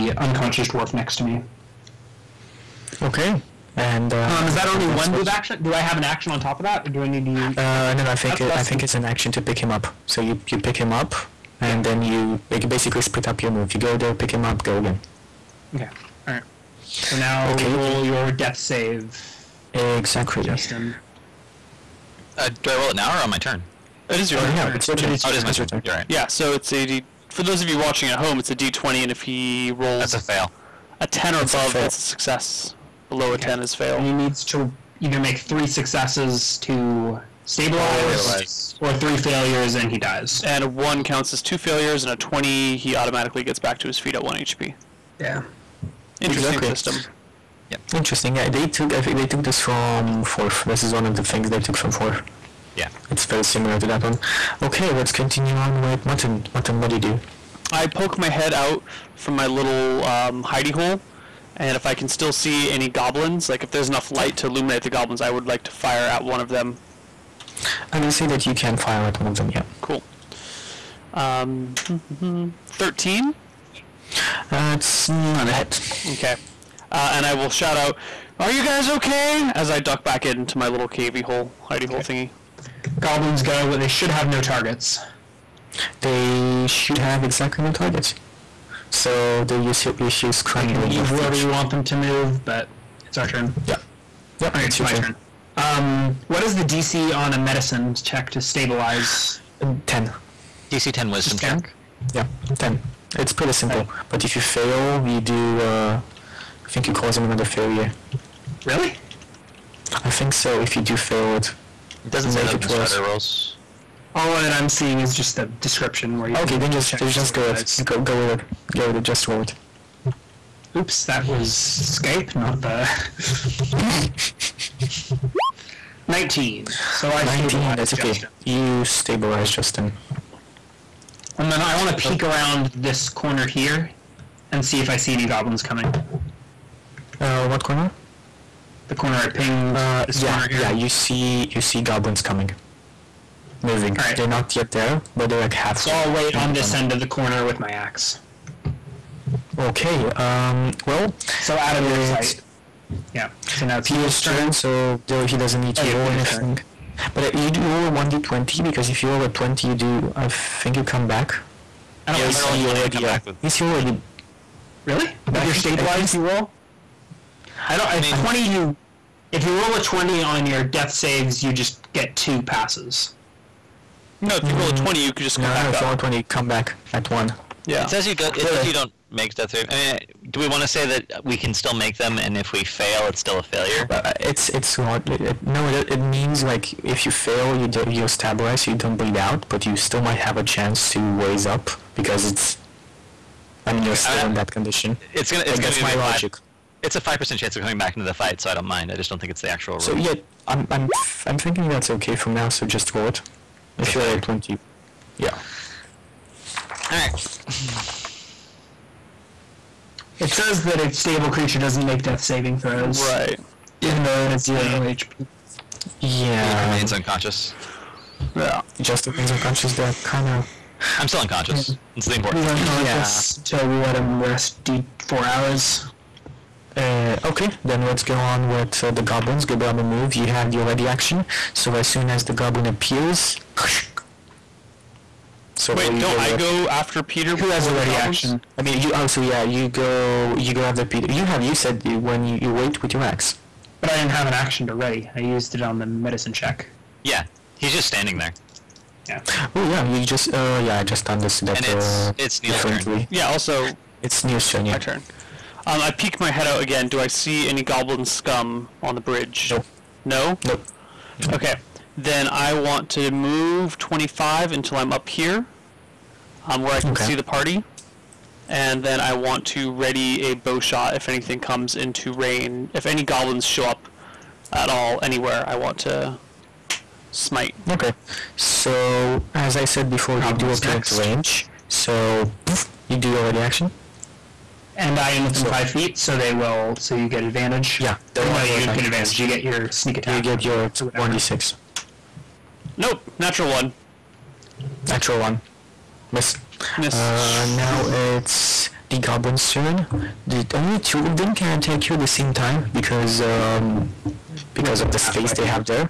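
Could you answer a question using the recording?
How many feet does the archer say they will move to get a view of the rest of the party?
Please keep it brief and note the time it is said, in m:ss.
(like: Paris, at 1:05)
25, at 4:23.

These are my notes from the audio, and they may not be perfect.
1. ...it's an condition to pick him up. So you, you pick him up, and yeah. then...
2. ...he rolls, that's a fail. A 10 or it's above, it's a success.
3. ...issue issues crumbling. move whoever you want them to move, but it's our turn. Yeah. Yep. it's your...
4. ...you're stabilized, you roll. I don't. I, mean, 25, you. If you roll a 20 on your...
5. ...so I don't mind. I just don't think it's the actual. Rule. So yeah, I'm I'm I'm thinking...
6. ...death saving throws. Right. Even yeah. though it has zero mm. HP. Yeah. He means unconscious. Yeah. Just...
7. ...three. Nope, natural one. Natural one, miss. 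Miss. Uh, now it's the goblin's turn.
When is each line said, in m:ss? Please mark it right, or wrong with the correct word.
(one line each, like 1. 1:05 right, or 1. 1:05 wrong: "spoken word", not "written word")
1. 0:08 wrong: "action", not "condition"
2. 0:29 right
3. 1:29 right
4. 2:45 wrong: "20", not "25"
5. 3:18 right
6. 3:32 wrong: "remains", not "means"
7. 4:51 wrong: "six", not "three".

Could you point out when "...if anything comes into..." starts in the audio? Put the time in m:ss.
4:30.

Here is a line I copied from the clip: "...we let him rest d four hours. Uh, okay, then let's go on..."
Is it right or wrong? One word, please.
right.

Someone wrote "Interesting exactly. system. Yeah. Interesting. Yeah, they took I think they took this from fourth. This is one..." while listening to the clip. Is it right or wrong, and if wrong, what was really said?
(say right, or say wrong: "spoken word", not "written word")
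right.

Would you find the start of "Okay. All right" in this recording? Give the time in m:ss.
0:15.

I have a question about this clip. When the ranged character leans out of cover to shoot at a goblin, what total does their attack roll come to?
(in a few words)
13.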